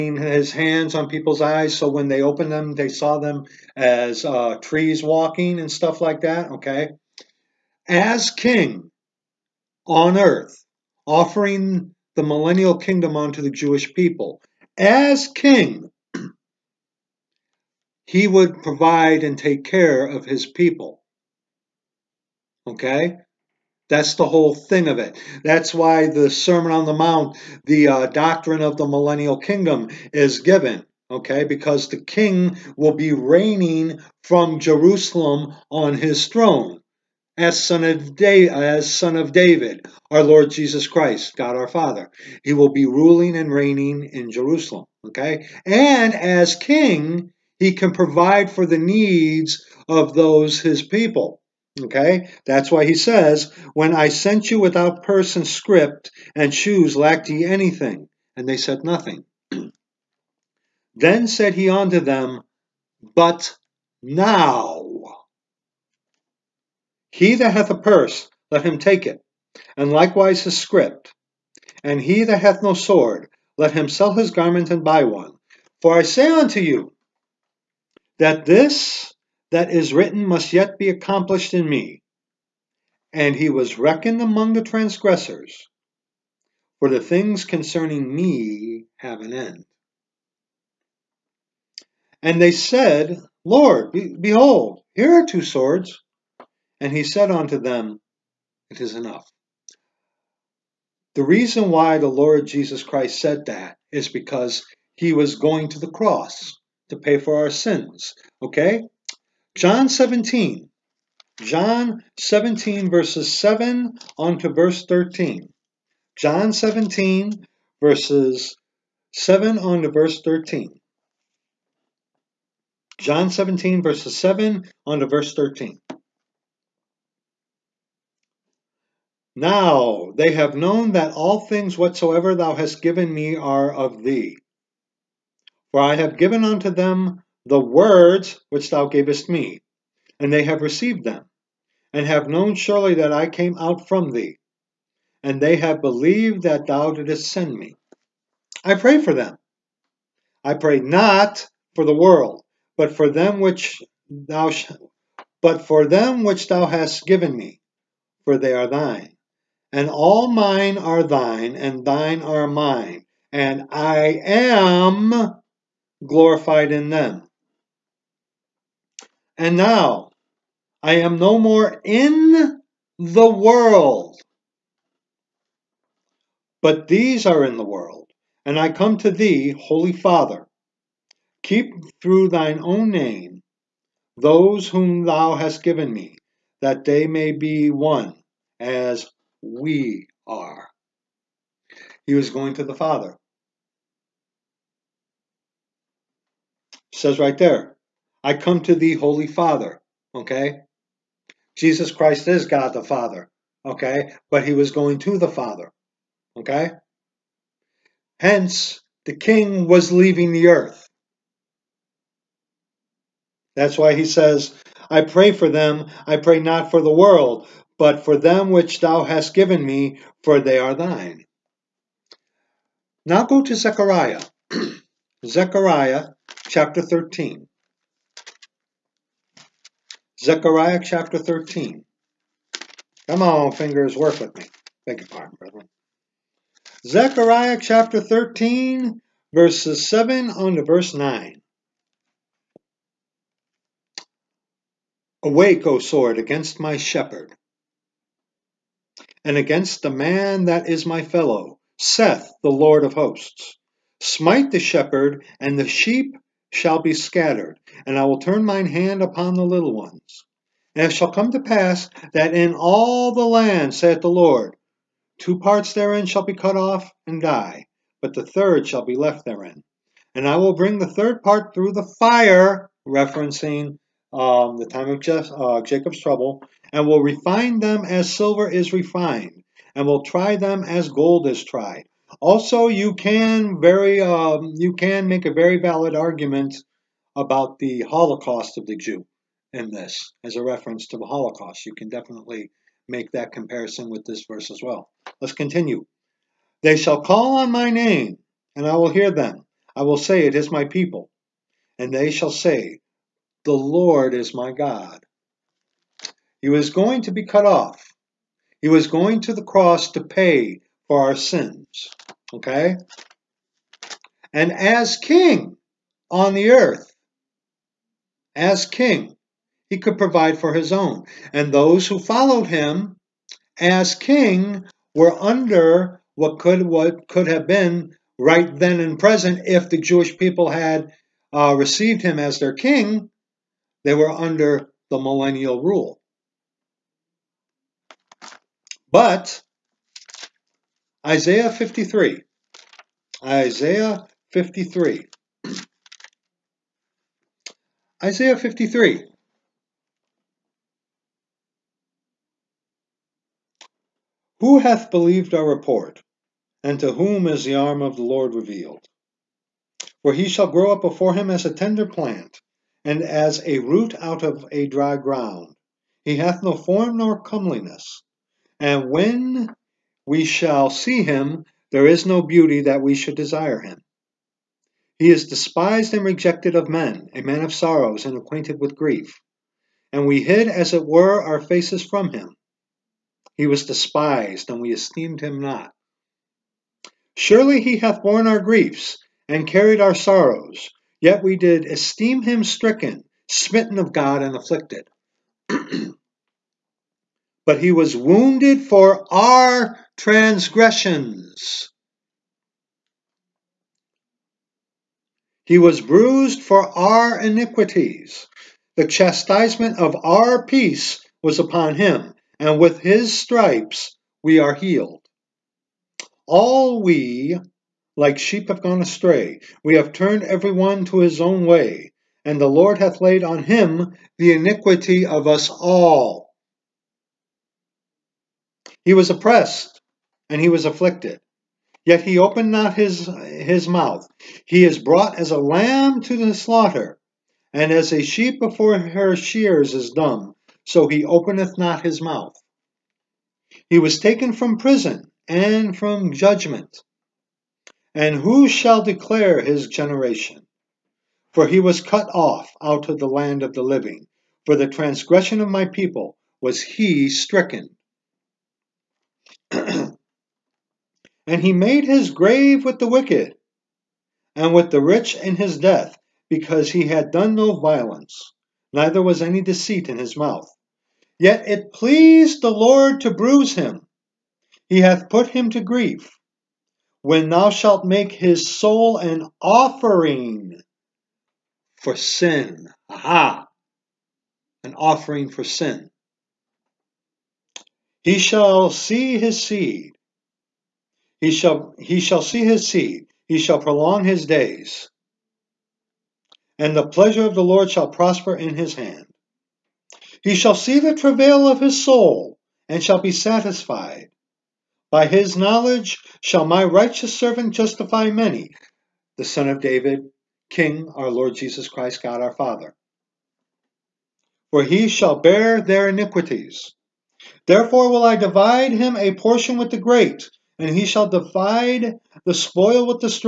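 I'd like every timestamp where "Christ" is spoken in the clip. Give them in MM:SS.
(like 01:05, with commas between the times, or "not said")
00:40, 01:42, 03:21, 08:31.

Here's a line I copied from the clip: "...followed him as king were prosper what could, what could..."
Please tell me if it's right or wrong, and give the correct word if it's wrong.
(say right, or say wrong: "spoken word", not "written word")
wrong: "under", not "prosper".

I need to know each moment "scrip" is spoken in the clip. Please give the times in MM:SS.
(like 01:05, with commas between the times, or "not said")
00:55, 01:10.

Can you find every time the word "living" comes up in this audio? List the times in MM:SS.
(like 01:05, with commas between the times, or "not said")
07:33.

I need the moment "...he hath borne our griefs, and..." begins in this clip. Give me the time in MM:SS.
06:27.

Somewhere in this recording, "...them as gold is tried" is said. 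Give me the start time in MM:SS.
04:40.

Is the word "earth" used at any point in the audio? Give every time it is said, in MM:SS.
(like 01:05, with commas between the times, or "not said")
00:10, 03:30, 05:16.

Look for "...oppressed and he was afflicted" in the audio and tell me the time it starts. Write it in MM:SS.
07:09.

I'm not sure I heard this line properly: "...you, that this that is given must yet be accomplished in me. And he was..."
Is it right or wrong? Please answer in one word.
wrong.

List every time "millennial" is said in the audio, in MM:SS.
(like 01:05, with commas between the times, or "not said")
00:12, 00:28, 05:34.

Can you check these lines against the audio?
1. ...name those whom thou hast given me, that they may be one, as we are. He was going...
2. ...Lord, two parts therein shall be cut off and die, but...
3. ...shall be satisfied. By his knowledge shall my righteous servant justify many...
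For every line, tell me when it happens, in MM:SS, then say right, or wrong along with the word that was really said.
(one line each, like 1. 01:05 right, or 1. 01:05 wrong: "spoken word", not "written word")
1. 03:02 right
2. 04:24 right
3. 08:22 right.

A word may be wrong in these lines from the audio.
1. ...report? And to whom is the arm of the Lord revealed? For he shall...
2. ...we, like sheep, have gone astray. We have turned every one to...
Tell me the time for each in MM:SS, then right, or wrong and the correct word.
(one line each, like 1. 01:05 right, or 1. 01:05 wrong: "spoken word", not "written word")
1. 05:55 right
2. 06:56 right.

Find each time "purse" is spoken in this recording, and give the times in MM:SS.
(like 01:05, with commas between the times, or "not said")
00:55, 01:07.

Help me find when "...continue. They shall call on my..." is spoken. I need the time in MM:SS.
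04:55.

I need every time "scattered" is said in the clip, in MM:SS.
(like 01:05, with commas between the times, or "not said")
04:16.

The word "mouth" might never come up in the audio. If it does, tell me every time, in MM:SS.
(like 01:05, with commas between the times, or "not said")
07:13, 07:22, 07:50.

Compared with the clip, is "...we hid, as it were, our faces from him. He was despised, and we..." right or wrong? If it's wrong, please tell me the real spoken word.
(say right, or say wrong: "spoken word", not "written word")
right.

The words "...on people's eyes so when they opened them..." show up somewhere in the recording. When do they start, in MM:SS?
00:00.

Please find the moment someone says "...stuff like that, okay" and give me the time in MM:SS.
00:05.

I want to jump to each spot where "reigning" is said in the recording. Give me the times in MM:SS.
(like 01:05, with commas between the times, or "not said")
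00:33, 00:43.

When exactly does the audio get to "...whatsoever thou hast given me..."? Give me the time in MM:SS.
02:11.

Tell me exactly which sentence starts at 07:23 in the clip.
He was taken from prison and from judgment.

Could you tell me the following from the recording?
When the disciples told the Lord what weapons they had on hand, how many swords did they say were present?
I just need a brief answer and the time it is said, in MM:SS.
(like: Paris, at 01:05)
2, at 01:35.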